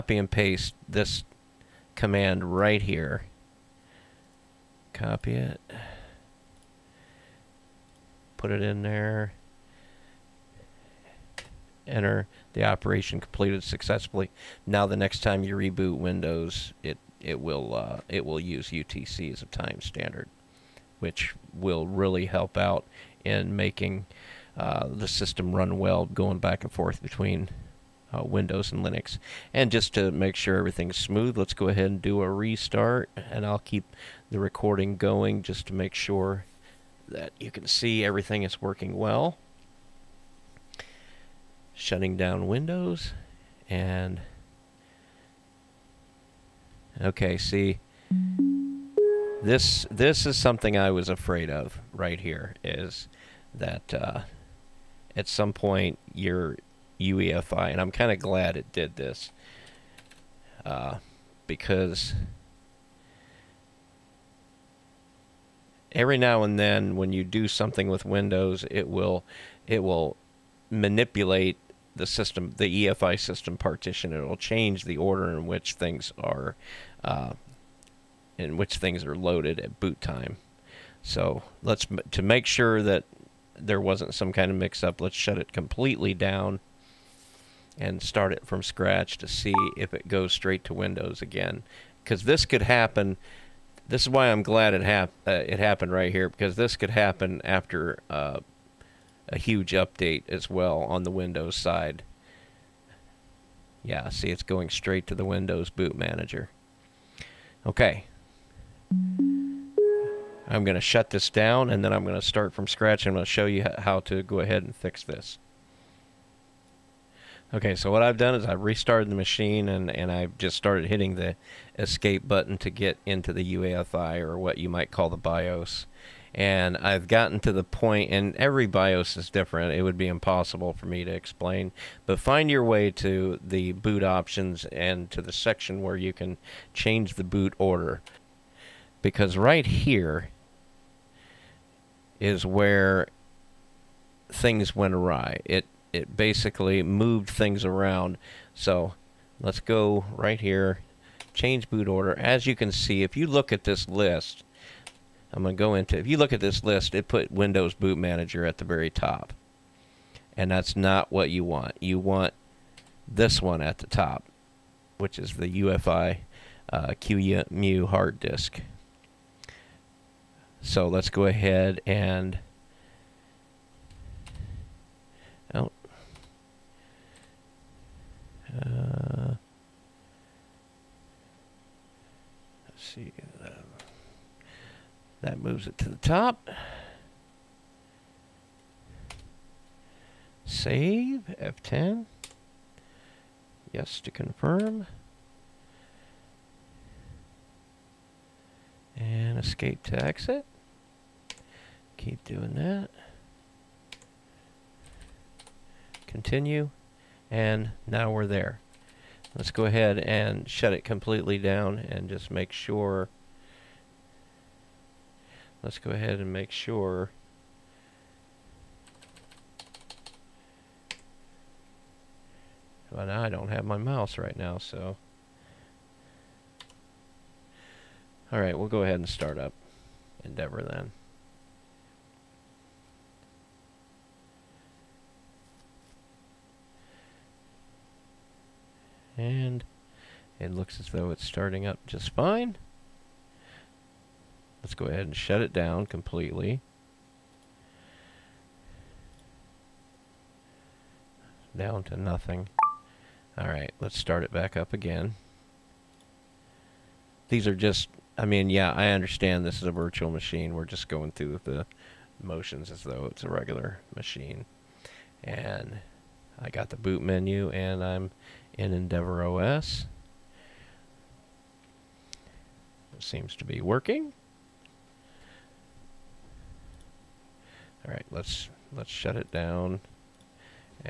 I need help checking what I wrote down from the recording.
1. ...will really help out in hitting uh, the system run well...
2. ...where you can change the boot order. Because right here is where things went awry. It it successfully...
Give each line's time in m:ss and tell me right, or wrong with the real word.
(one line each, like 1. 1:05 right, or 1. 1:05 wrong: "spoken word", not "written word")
1. 0:21 wrong: "making", not "hitting"
2. 2:15 wrong: "basically", not "successfully".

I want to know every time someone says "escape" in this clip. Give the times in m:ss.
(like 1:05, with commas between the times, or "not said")
2:01, 3:19.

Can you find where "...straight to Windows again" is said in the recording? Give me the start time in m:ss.
1:30.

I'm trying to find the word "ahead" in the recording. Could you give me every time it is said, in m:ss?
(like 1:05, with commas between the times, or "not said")
0:31, 1:54, 2:51, 3:29, 3:35, 3:48, 4:04.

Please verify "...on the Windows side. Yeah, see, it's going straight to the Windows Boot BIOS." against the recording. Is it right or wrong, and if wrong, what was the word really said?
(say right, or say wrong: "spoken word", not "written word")
wrong: "Manager", not "BIOS".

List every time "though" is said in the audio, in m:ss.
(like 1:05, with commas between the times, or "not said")
4:00, 4:22.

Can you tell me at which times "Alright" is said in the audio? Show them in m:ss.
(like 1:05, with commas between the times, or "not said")
4:13.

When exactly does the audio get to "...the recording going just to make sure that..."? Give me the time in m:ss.
0:34.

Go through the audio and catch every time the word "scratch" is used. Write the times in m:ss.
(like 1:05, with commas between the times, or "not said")
1:28, 1:52.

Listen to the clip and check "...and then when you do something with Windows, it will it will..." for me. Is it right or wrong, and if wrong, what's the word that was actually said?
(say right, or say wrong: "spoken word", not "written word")
right.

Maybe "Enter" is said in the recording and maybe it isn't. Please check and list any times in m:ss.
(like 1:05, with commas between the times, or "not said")
0:11.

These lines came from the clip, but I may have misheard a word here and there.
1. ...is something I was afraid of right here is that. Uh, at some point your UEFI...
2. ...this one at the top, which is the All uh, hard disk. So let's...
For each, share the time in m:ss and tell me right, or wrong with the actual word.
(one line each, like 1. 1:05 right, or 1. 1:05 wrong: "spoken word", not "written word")
1. 0:50 right
2. 2:43 wrong: "UEFI", not "All".